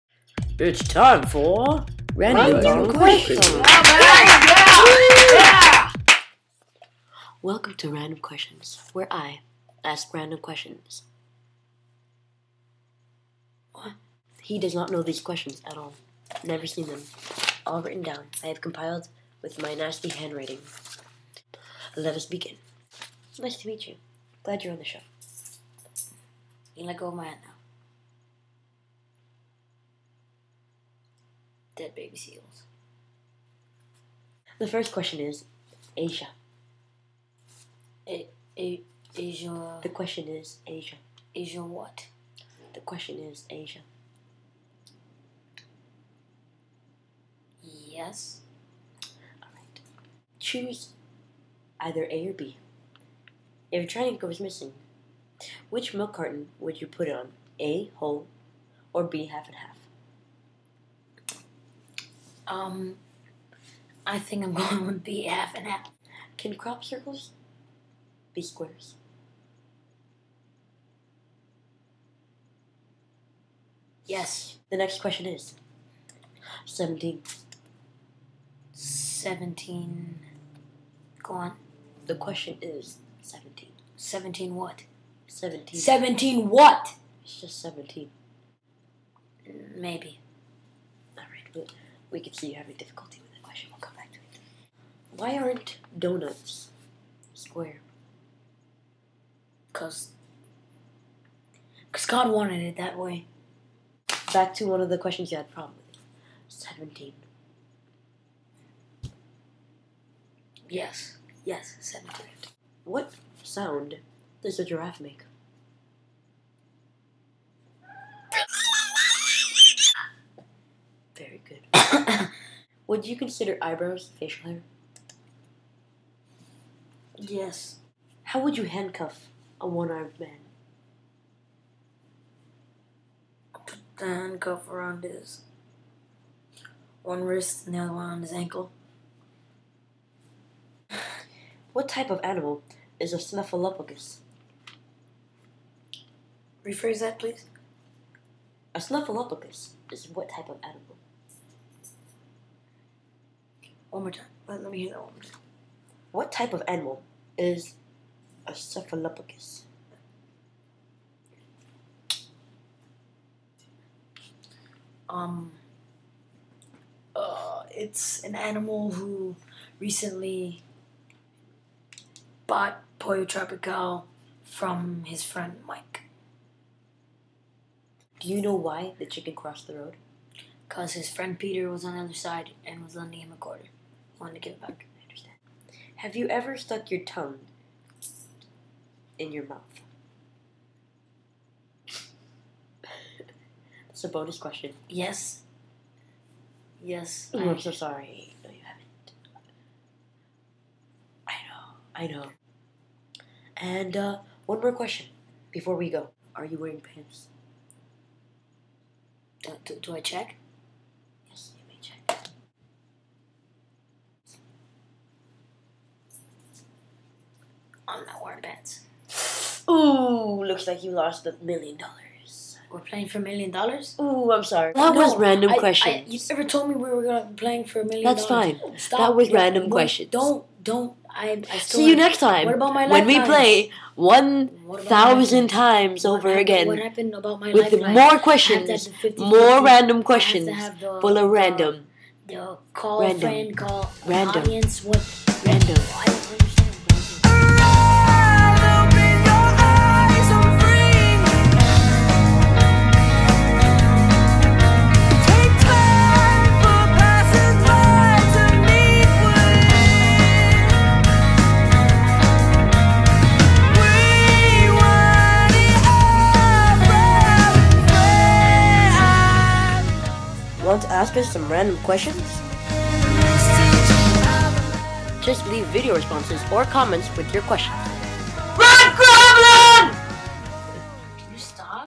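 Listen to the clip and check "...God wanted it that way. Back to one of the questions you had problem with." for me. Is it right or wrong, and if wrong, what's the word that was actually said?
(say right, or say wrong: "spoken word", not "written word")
right.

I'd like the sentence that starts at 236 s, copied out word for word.
What happened about my With life more questions, more random questions, full of random.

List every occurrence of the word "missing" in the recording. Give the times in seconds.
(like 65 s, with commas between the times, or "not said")
54 s.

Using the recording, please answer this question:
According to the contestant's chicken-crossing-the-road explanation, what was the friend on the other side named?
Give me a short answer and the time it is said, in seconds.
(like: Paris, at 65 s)
Peter, at 181 s.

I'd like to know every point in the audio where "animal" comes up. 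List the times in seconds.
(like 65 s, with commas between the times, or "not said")
142 s, 150 s, 156 s, 168 s.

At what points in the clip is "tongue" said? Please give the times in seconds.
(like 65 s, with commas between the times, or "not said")
187 s.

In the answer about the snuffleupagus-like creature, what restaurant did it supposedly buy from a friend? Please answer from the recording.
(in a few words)
Pollo Tropical.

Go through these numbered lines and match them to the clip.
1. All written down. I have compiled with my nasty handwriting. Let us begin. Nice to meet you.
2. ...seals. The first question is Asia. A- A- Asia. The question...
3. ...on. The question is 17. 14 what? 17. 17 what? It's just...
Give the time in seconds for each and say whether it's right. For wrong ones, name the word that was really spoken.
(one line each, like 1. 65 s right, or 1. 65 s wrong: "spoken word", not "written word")
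1. 17 s right
2. 32 s right
3. 81 s wrong: "17", not "14".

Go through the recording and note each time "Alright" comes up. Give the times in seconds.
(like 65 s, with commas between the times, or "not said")
49 s, 91 s.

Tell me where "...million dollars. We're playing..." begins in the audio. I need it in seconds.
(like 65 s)
221 s.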